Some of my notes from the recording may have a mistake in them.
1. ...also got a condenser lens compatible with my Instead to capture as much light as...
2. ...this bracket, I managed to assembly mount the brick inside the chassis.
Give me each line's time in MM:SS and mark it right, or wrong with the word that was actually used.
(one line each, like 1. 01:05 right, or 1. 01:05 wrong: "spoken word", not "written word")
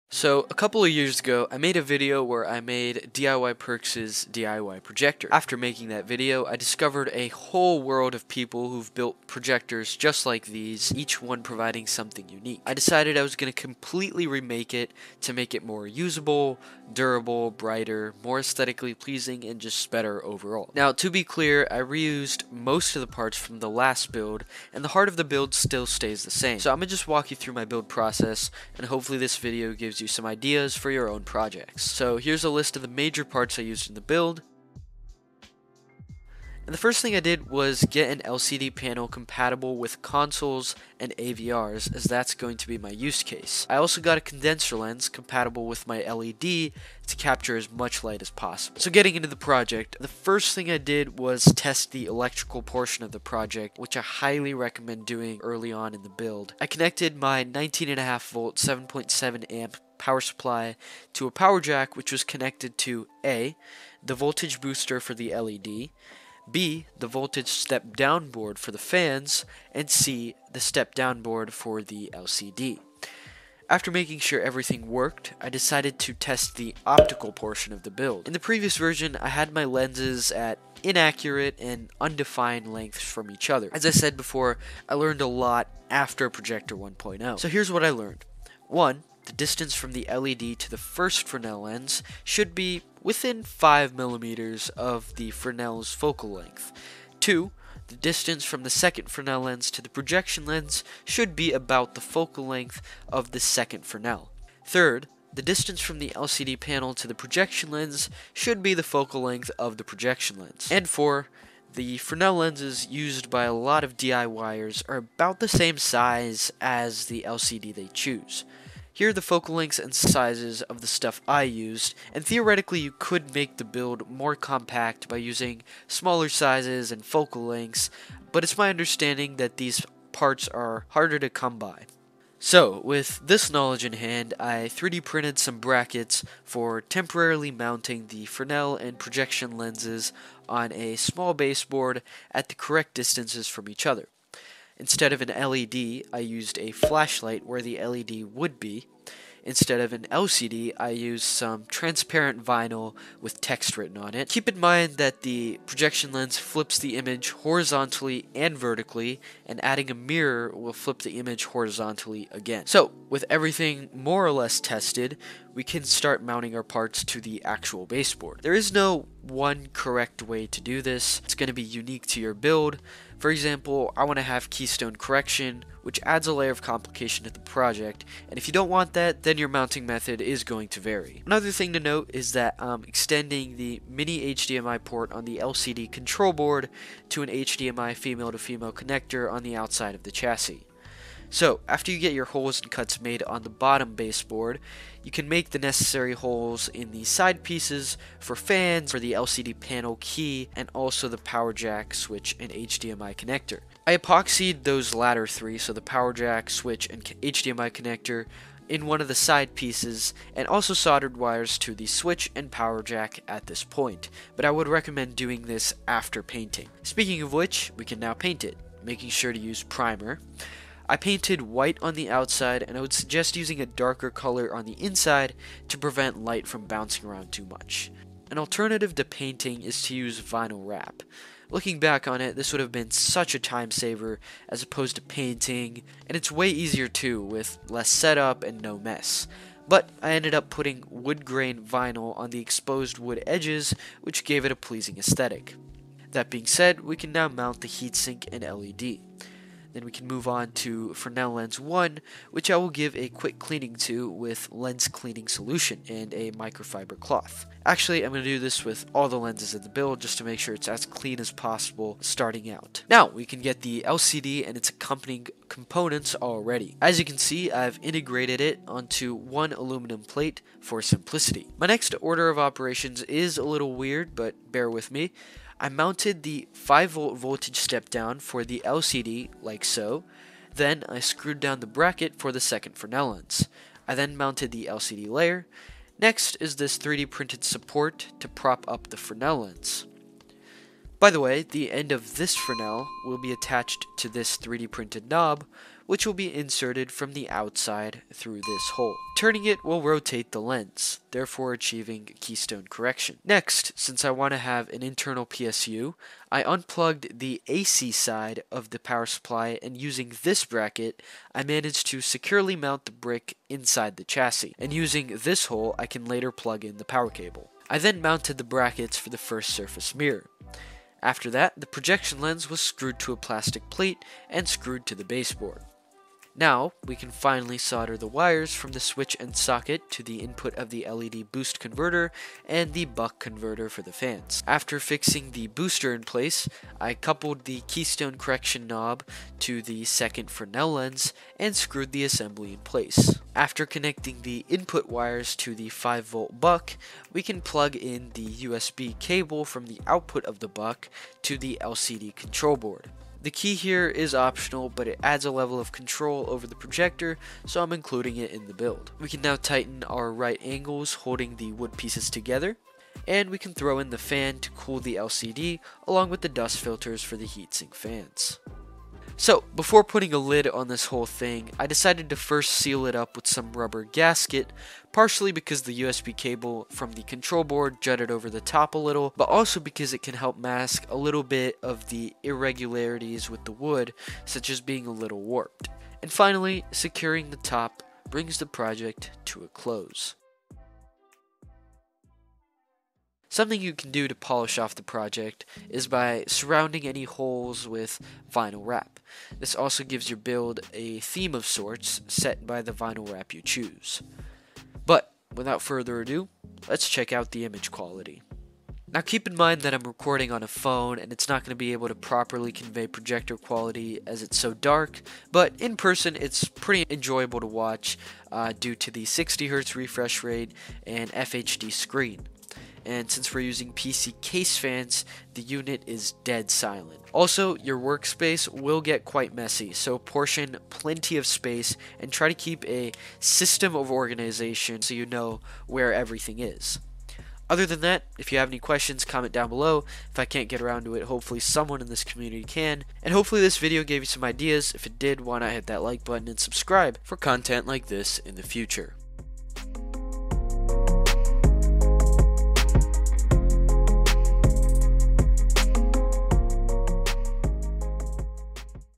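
1. 00:43 wrong: "LED", not "Instead"
2. 05:10 wrong: "securely", not "assembly".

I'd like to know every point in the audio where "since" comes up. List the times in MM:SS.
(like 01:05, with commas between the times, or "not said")
05:03, 07:03.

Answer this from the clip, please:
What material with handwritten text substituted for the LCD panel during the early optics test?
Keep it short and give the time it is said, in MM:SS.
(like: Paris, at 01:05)
Transparent vinyl, at 02:31.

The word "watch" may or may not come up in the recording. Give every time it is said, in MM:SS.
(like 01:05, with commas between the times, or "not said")
06:57.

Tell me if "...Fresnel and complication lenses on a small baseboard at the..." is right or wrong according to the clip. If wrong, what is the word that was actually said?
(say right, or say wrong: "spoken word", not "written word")
wrong: "projection", not "complication".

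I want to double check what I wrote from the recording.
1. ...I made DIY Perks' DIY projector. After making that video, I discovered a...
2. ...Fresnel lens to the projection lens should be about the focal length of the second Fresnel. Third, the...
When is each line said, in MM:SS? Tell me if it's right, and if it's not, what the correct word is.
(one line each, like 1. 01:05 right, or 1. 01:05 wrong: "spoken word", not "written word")
1. 00:02 right
2. 01:39 right.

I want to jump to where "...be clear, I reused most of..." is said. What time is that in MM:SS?
00:21.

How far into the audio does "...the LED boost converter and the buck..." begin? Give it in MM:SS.
05:30.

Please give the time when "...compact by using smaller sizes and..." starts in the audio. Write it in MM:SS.
02:04.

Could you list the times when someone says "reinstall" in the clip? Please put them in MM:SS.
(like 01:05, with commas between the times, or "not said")
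not said.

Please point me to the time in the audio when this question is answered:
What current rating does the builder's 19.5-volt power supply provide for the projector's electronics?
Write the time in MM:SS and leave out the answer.
00:58.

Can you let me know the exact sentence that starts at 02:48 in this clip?
There is no one correct way to do this.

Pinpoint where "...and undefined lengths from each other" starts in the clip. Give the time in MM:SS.
01:21.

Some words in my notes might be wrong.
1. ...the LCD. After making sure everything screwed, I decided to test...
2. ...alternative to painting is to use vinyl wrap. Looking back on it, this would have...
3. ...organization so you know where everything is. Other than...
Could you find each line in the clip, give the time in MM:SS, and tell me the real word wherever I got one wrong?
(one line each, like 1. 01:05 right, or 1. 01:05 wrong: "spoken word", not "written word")
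1. 01:11 wrong: "worked", not "screwed"
2. 03:48 right
3. 07:13 right.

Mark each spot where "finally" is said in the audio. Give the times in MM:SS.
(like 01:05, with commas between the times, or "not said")
05:27, 06:26.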